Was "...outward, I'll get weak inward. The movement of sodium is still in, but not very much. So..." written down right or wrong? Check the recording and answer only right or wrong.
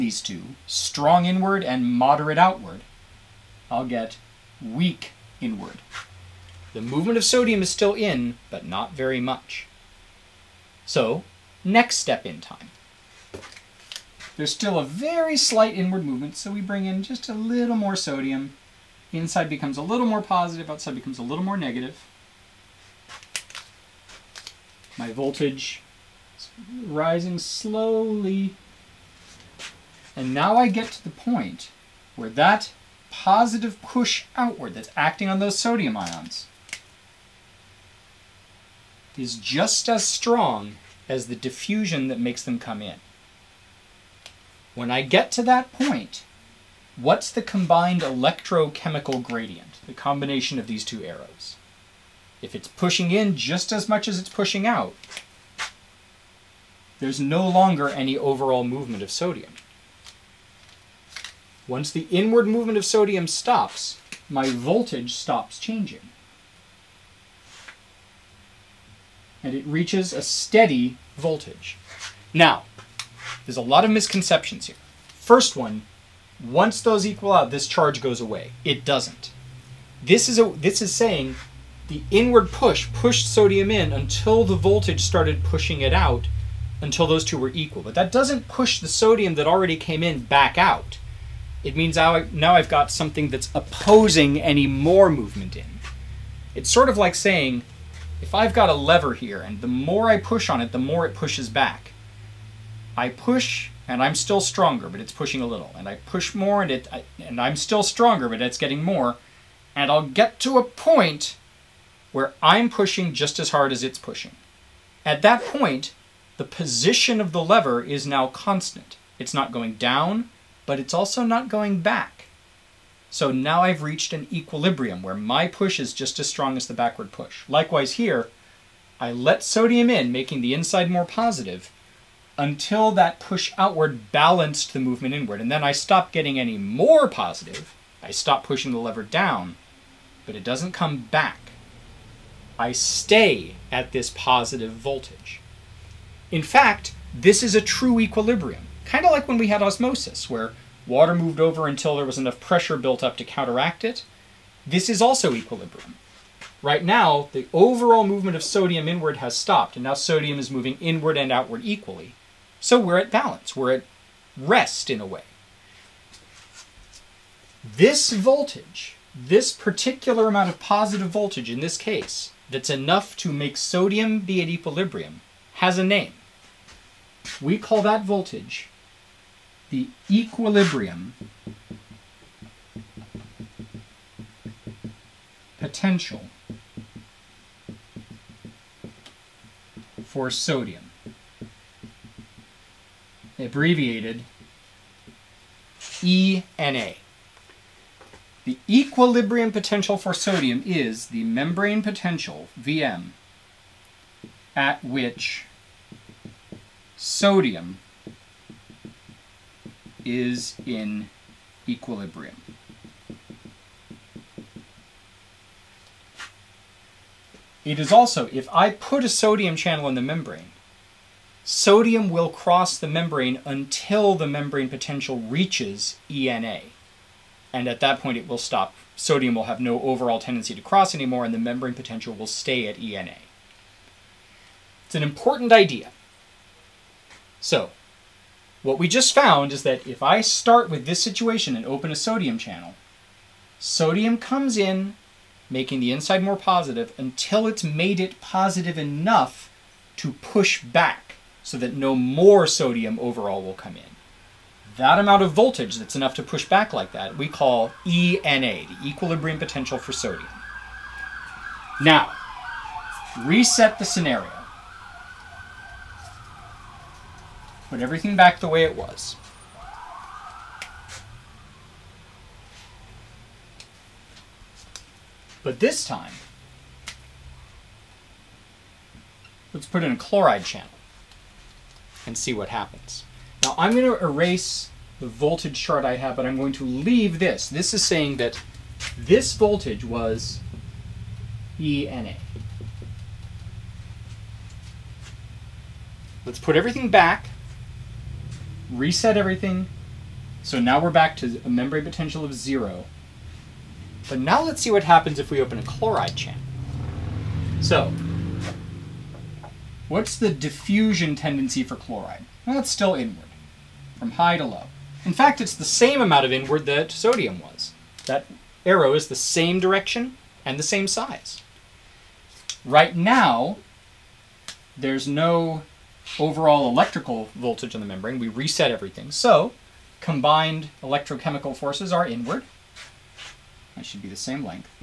right.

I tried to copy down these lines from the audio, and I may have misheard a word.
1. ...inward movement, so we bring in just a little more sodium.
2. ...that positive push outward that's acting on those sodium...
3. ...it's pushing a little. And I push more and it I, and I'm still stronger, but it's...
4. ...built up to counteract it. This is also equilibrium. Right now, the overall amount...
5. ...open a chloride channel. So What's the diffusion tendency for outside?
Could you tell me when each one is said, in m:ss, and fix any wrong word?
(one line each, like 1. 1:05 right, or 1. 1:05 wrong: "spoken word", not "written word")
1. 0:15 right
2. 0:32 right
3. 1:44 right
4. 2:32 wrong: "movement", not "amount"
5. 5:05 wrong: "chloride", not "outside".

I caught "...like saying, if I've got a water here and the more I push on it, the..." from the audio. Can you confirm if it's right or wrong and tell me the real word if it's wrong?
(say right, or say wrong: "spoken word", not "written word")
wrong: "lever", not "water".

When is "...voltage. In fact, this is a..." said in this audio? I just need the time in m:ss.
2:24.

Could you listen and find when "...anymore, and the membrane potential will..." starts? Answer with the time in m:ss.
3:50.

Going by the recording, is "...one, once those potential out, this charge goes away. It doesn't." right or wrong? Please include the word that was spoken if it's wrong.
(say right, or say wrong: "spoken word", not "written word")
wrong: "equal", not "potential".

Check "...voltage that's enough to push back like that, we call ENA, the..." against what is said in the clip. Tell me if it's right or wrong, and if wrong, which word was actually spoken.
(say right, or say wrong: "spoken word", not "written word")
right.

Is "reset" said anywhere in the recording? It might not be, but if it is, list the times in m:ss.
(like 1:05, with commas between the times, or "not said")
4:23, 4:58, 5:28.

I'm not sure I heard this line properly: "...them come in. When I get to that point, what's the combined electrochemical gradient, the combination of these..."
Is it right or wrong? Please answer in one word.
right.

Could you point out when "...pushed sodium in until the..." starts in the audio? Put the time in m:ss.
1:22.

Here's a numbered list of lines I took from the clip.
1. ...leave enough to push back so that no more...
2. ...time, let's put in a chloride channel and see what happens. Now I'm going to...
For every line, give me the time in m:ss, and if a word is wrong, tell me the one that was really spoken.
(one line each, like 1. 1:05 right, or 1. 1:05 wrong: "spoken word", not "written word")
1. 4:08 wrong: "positive", not "leave"
2. 4:35 right.